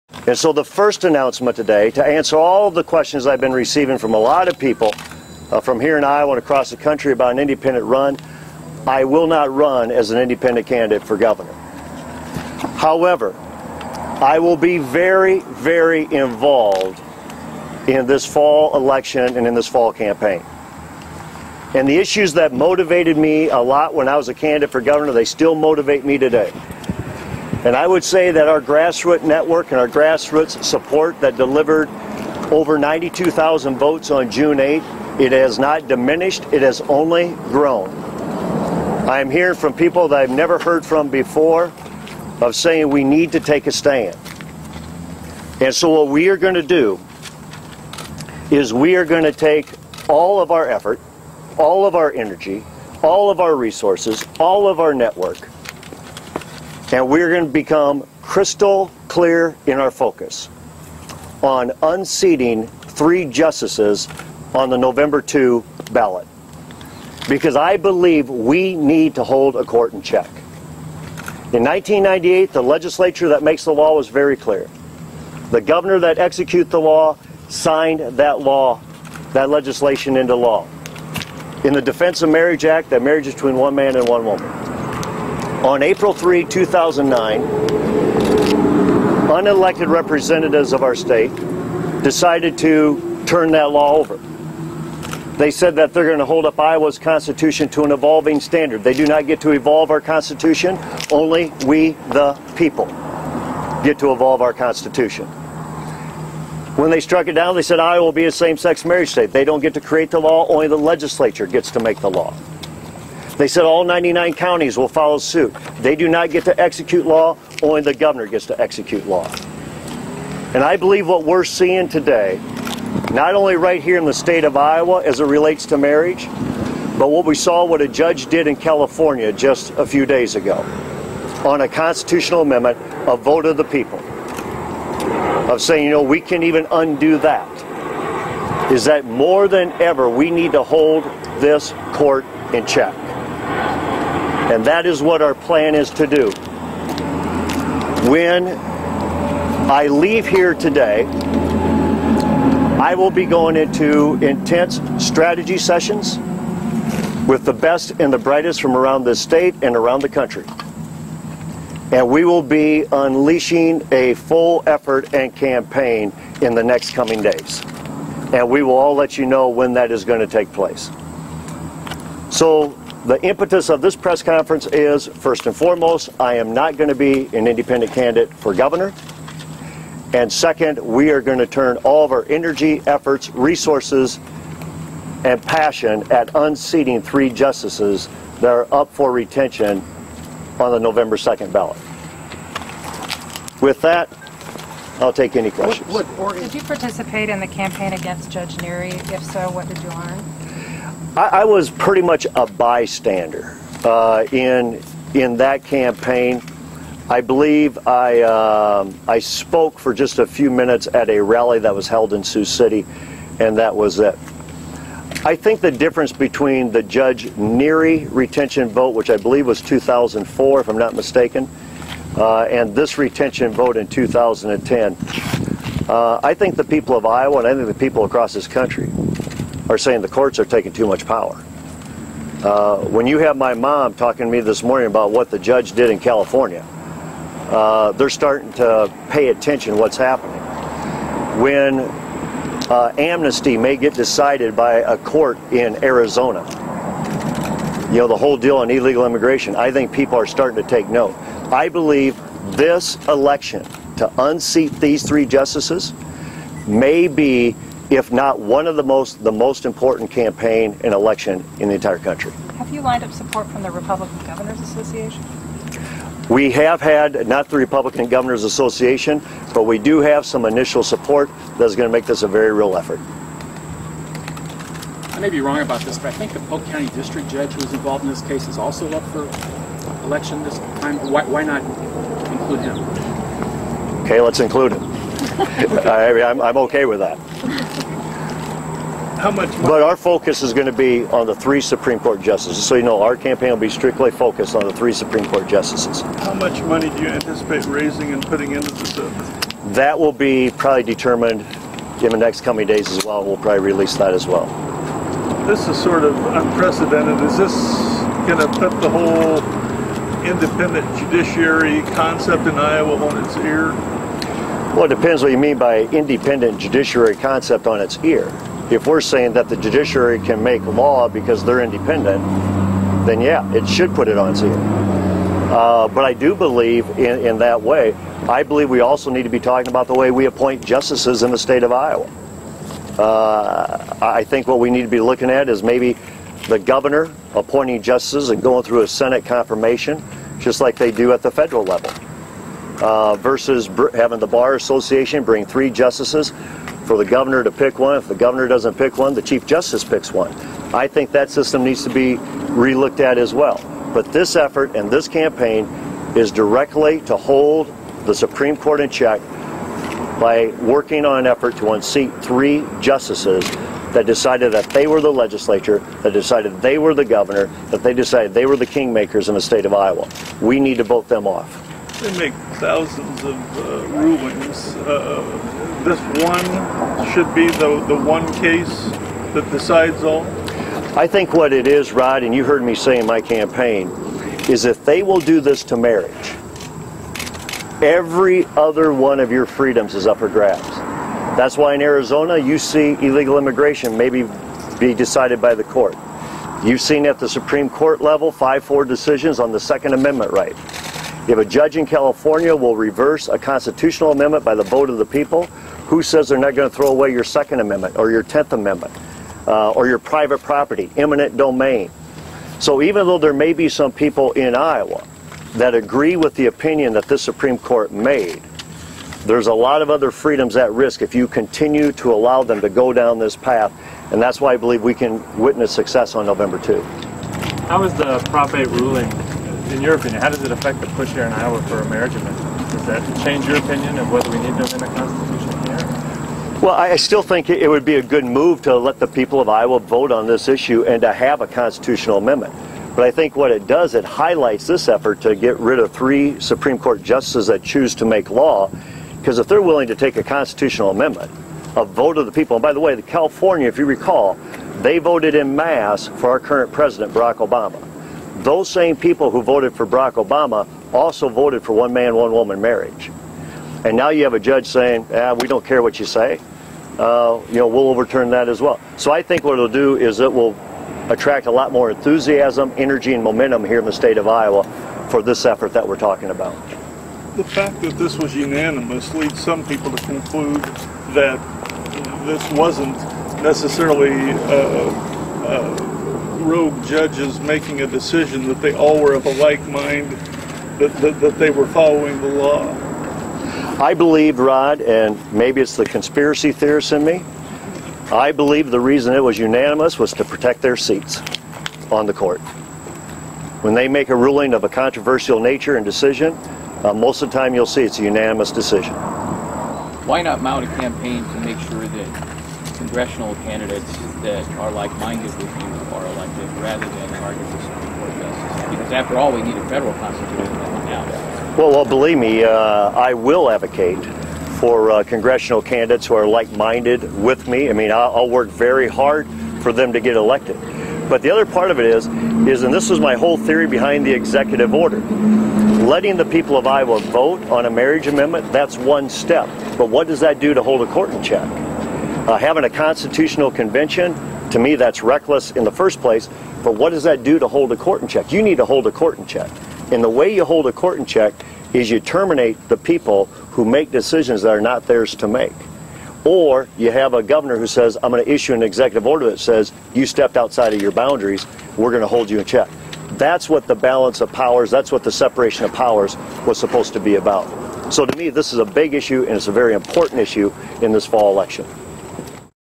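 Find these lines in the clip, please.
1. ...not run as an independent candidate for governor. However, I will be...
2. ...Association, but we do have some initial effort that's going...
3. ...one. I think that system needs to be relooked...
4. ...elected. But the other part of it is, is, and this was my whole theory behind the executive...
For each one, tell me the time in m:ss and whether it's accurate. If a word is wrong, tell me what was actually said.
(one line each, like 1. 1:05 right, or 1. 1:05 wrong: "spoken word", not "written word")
1. 0:09 right
2. 4:28 wrong: "support", not "effort"
3. 5:50 right
4. 8:50 right.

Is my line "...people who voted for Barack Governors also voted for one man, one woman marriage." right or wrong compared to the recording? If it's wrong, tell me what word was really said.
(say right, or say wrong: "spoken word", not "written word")
wrong: "Obama", not "Governors".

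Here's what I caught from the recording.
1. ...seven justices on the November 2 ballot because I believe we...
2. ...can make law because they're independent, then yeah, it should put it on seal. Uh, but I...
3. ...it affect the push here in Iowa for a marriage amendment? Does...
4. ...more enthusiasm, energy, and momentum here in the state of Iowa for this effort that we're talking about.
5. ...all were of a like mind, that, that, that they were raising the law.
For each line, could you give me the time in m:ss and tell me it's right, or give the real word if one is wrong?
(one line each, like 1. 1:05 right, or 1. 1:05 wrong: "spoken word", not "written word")
1. 1:02 wrong: "three", not "seven"
2. 5:20 right
3. 7:10 right
4. 7:51 right
5. 8:08 wrong: "following", not "raising".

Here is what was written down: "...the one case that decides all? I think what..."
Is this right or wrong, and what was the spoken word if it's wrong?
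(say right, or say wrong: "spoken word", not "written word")
right.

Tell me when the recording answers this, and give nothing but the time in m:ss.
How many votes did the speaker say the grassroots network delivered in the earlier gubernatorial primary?
0:32.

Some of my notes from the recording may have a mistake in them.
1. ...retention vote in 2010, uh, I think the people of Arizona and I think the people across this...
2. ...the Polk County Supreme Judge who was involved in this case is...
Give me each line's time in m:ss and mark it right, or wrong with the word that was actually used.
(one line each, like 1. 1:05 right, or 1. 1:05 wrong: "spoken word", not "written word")
1. 3:42 wrong: "Iowa", not "Arizona"
2. 4:36 wrong: "District", not "Supreme".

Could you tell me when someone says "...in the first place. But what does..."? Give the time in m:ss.
9:05.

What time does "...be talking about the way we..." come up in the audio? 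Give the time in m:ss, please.
5:29.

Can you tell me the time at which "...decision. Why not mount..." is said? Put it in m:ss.
8:28.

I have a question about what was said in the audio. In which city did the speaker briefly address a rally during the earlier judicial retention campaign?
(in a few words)
Sioux City.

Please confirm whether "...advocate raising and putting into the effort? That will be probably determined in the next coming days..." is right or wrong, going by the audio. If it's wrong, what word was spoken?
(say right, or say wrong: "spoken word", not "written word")
wrong: "anticipate", not "advocate".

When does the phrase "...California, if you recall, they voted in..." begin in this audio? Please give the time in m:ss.
7:33.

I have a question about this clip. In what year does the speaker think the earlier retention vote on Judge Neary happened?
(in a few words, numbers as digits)
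2004.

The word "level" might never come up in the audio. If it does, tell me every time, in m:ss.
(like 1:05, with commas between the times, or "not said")
5:41, 6:38.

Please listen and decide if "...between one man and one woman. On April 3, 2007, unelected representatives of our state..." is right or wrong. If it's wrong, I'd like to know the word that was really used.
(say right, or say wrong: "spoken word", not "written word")
wrong: "2009", not "2007".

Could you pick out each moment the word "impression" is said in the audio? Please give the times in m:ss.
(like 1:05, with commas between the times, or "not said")
not said.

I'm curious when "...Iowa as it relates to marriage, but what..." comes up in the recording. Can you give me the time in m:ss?
2:04.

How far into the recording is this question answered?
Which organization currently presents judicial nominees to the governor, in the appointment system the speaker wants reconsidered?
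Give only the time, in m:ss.
5:44.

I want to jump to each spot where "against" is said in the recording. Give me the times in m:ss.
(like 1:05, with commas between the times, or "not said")
3:17.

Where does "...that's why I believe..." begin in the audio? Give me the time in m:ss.
7:04.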